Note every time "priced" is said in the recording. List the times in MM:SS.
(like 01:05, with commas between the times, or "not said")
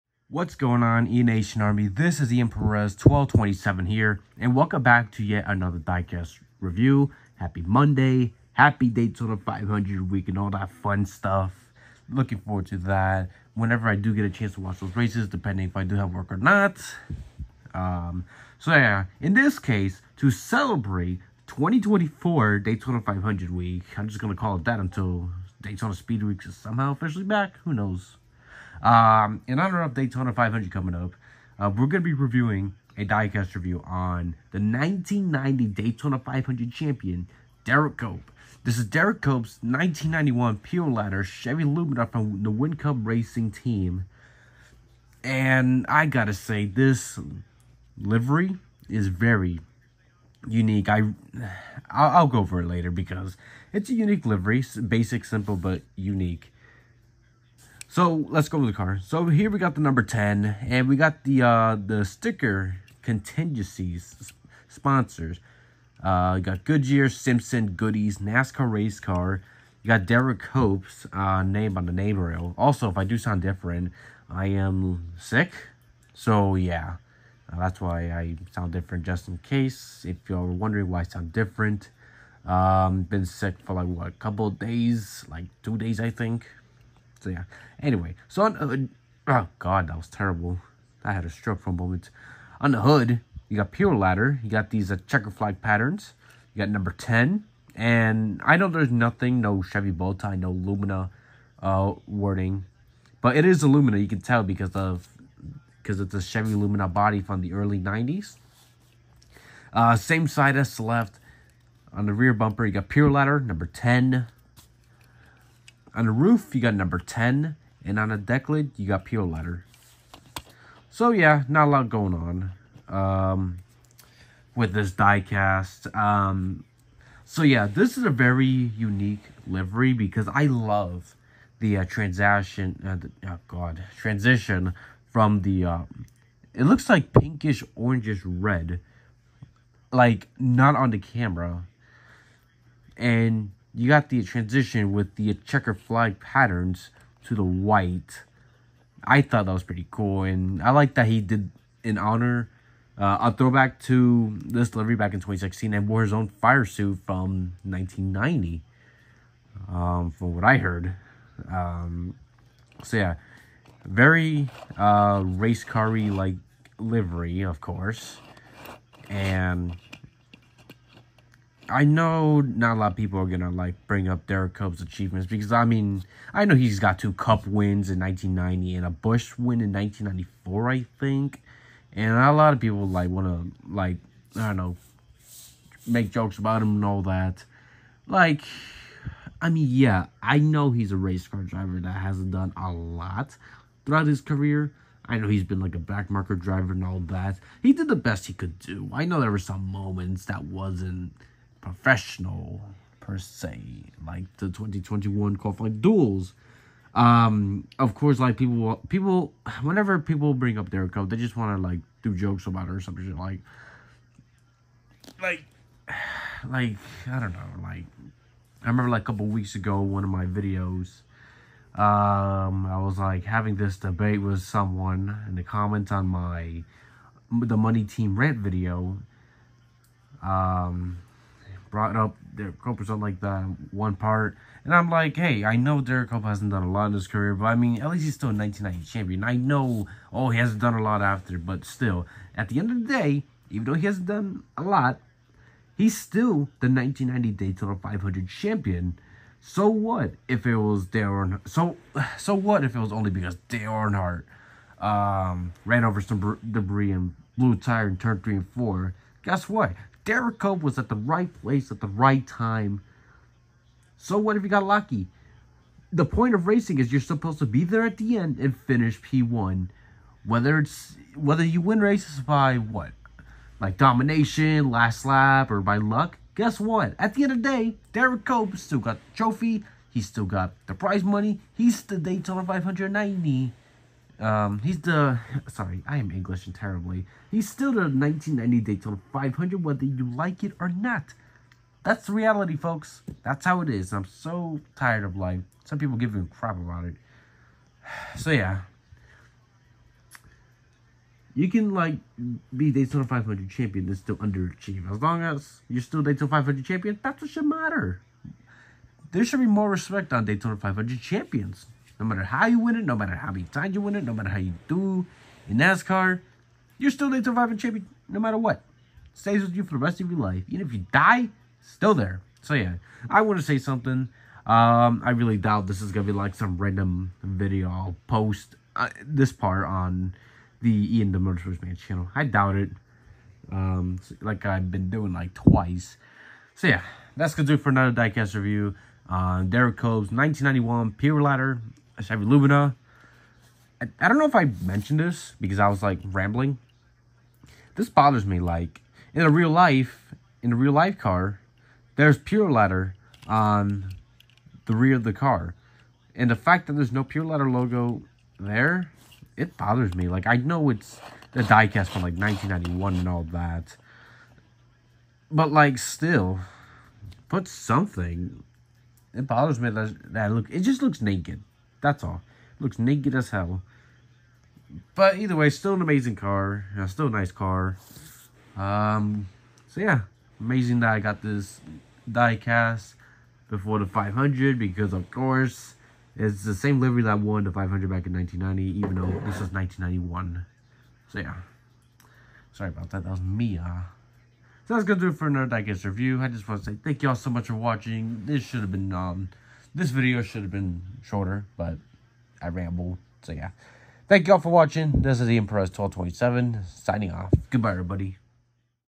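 not said.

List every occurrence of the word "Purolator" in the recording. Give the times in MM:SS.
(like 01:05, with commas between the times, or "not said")
00:40, 01:33, 01:52, 01:59, 05:40, 05:52, 05:57.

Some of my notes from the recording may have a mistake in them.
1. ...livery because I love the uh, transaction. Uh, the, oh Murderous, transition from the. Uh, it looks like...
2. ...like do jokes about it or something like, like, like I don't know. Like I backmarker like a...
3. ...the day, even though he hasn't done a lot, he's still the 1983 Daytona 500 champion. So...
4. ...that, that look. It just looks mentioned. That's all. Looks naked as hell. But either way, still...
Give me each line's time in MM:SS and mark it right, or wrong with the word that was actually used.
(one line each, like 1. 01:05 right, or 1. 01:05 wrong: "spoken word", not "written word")
1. 02:09 wrong: "God", not "Murderous"
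2. 03:31 wrong: "remember", not "backmarker"
3. 04:02 wrong: "1990", not "1983"
4. 06:09 wrong: "naked", not "mentioned".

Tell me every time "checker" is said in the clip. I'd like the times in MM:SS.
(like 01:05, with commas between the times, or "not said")
01:35, 02:25.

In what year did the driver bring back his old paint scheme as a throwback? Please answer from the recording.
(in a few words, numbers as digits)
2016.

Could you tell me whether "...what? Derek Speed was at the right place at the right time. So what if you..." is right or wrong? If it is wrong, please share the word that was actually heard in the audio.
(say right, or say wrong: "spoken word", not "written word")
wrong: "Jericho", not "Speed".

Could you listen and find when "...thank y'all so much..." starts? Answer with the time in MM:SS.
06:36.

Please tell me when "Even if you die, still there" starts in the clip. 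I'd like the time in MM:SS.
05:20.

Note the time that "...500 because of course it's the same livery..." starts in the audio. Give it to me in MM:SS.
06:23.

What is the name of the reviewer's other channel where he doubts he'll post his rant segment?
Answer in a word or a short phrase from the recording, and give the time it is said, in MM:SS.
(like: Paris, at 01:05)
Ian the Murderous Man, at 05:30.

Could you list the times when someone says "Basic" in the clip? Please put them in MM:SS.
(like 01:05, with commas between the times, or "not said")
00:54.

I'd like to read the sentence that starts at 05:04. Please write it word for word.
As long as you're still Daytona 500 champion, that's what should matter.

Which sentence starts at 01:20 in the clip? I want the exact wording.
If you're wondering why I sound different, um, been sick for like what, a couple days, like two days I think.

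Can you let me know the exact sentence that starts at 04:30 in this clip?
Whether it's whether you win races by what?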